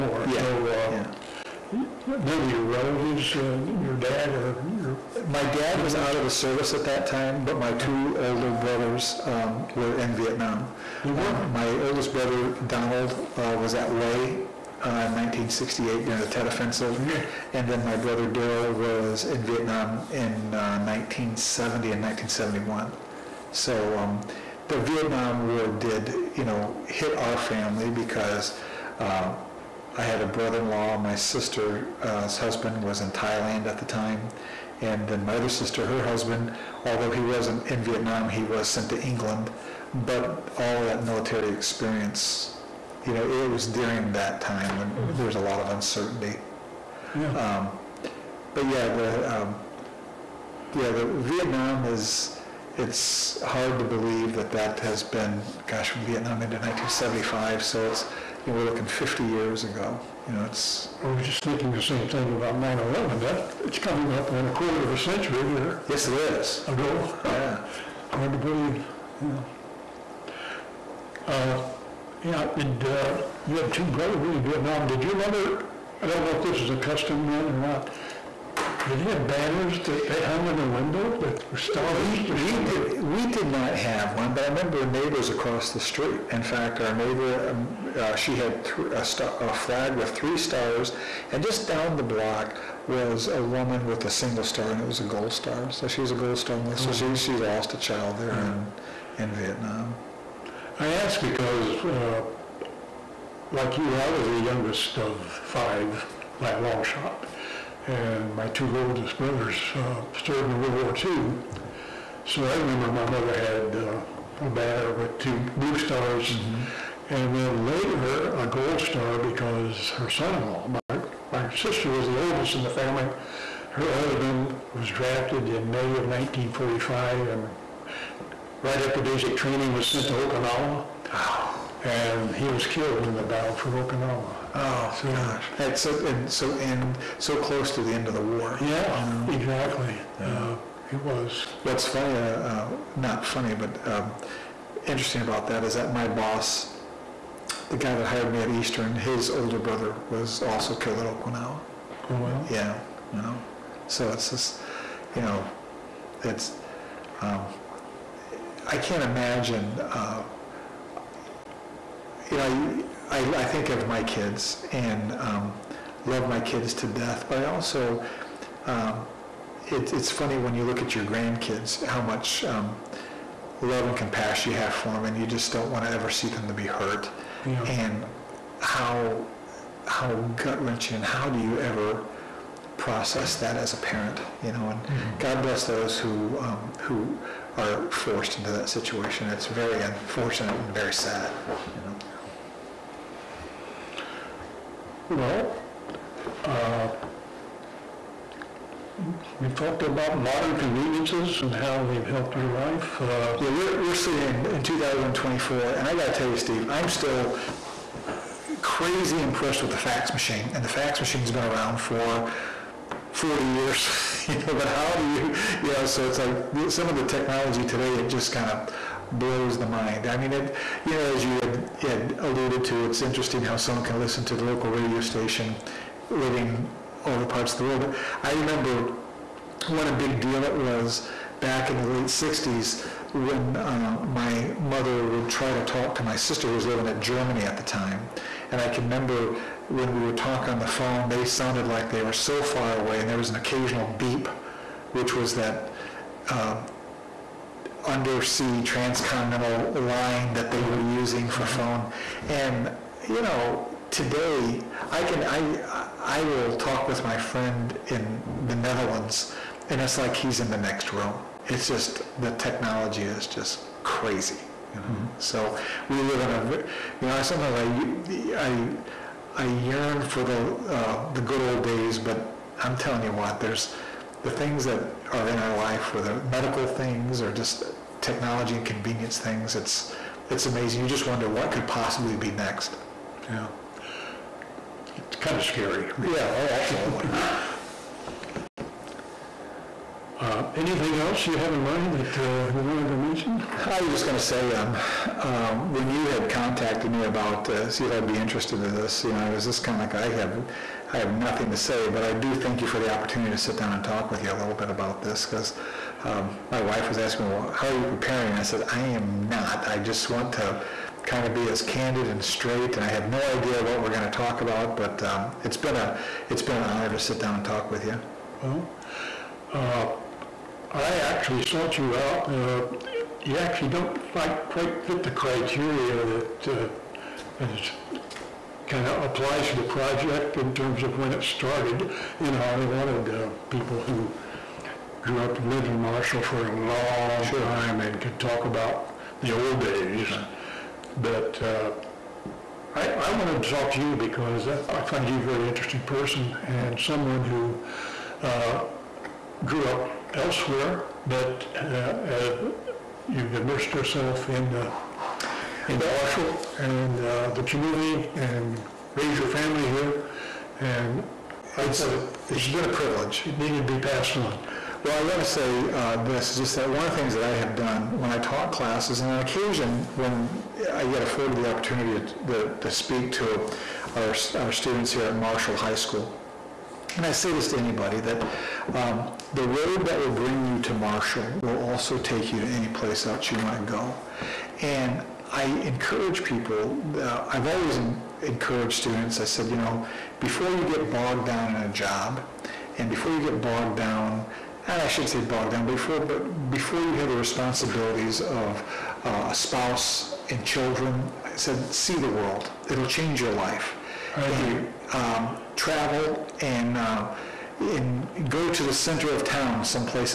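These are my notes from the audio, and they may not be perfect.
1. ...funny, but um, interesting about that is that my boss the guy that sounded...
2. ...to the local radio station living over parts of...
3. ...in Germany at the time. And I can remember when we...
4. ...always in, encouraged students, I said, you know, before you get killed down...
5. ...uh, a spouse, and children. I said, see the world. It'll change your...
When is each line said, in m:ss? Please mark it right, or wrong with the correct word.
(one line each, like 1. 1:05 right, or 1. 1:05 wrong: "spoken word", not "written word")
1. 2:23 wrong: "hired", not "sounded"
2. 3:44 right
3. 3:56 right
4. 6:27 wrong: "bogged", not "killed"
5. 6:39 right.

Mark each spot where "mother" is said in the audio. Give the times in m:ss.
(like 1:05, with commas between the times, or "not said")
1:15, 1:53, 3:54.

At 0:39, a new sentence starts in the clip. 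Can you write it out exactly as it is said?
But all of that military experience, you know, it was during that time when mm-hmm.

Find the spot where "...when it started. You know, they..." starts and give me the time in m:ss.
5:30.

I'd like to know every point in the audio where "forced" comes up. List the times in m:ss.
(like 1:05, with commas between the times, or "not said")
3:07.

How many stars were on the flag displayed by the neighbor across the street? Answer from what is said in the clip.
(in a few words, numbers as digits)
3.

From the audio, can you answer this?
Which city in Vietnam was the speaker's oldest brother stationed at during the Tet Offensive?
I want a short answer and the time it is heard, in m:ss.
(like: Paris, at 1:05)
Hue, at 0:13.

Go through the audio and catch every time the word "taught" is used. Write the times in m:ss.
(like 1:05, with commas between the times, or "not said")
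6:08.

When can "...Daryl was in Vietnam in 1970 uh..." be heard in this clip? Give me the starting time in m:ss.
0:18.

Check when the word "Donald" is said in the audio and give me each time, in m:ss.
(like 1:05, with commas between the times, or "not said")
0:12.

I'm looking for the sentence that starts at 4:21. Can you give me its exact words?
It's just the technology is just crazy.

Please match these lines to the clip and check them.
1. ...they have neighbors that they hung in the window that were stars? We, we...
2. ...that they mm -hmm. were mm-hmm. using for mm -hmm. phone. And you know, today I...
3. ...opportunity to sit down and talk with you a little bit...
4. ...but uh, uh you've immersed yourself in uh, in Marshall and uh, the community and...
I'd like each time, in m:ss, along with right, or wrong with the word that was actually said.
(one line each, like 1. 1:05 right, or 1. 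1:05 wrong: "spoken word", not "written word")
1. 1:18 wrong: "banners", not "neighbors"
2. 4:10 right
3. 5:02 right
4. 5:51 right.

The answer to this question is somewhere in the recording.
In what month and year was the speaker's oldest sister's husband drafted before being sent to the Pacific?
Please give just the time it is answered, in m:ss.
2:05.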